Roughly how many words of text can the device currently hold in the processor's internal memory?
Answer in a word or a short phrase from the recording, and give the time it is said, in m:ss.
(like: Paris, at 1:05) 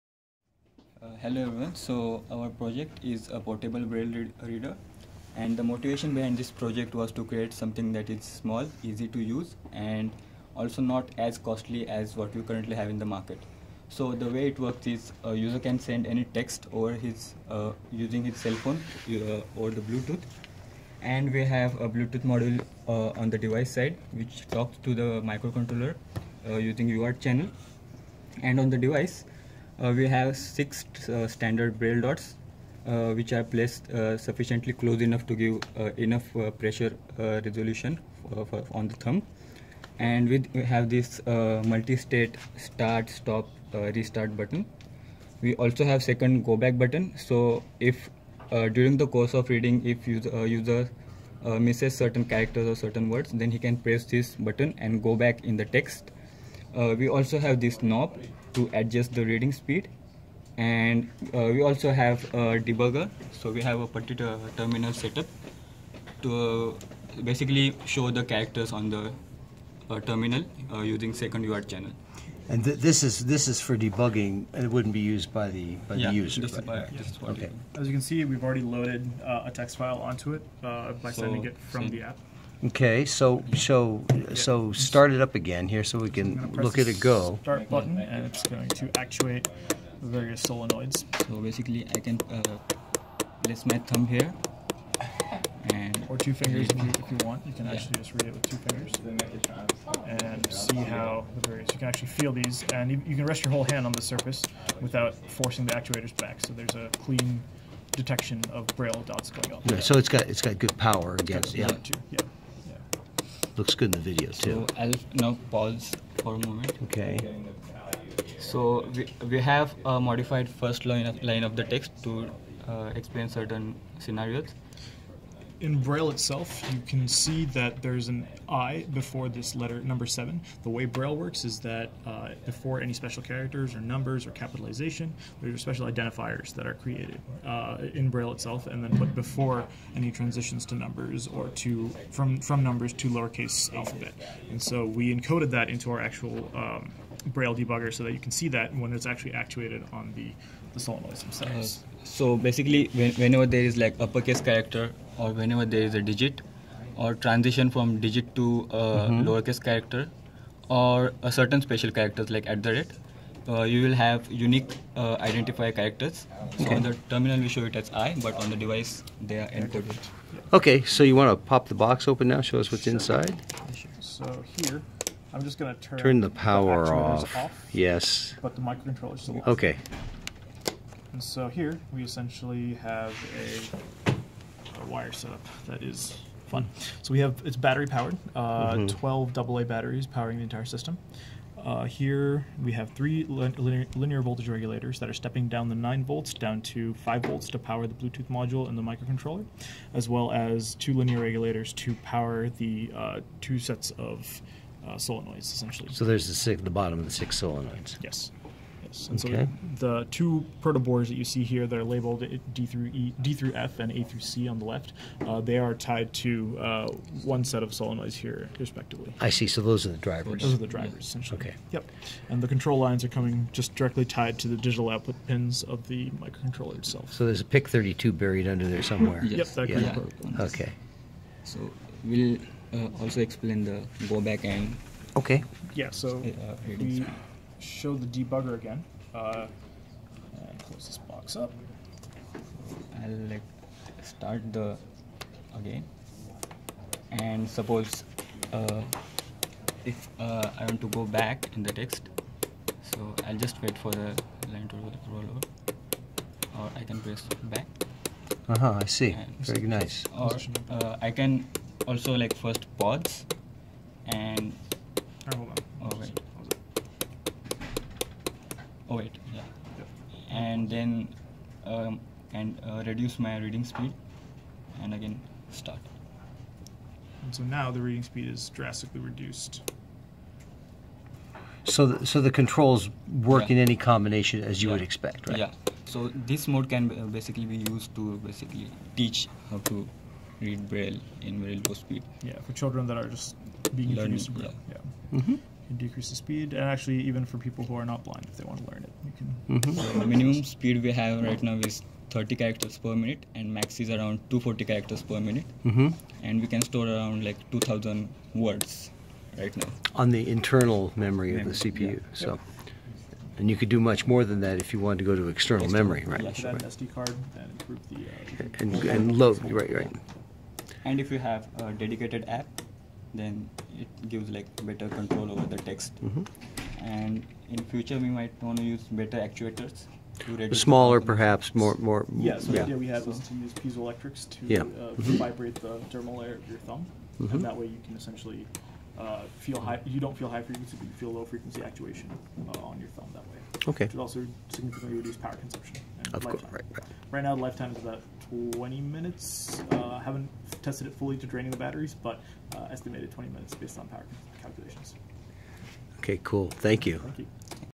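2,000, at 5:07.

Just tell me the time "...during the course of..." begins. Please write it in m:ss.
0:48.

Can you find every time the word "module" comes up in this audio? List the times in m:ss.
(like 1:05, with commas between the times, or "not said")
0:22, 3:18.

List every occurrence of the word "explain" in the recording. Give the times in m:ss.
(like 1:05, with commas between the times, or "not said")
2:02, 3:53.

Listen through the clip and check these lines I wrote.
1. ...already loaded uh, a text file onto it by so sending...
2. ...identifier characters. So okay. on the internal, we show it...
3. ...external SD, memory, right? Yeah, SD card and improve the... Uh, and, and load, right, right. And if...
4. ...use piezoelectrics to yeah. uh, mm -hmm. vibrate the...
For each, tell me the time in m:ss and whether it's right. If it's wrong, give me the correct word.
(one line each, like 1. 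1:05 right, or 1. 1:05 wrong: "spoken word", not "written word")
1. 1:18 right
2. 2:45 wrong: "terminal", not "internal"
3. 5:15 right
4. 5:33 right.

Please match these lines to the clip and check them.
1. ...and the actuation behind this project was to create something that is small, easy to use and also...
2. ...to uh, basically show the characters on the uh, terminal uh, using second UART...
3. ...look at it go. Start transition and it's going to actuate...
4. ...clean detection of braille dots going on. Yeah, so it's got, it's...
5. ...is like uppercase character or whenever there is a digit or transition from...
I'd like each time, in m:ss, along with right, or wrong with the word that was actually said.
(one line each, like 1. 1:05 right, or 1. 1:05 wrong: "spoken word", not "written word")
1. 0:05 wrong: "motivation", not "actuation"
2. 1:06 right
3. 1:26 wrong: "button", not "transition"
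4. 1:46 right
5. 2:33 right.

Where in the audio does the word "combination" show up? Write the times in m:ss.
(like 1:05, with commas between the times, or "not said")
4:43.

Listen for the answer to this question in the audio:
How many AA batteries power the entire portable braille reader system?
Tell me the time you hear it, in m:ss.
3:08.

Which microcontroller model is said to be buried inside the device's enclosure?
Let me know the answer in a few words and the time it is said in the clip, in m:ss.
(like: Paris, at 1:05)
PIC32, at 3:47.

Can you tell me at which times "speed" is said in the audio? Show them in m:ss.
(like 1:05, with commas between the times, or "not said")
0:59, 4:33, 4:38, 4:51, 4:56, 5:00.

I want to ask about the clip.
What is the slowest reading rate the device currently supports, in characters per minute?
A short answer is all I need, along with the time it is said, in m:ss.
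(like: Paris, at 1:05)
30, at 5:02.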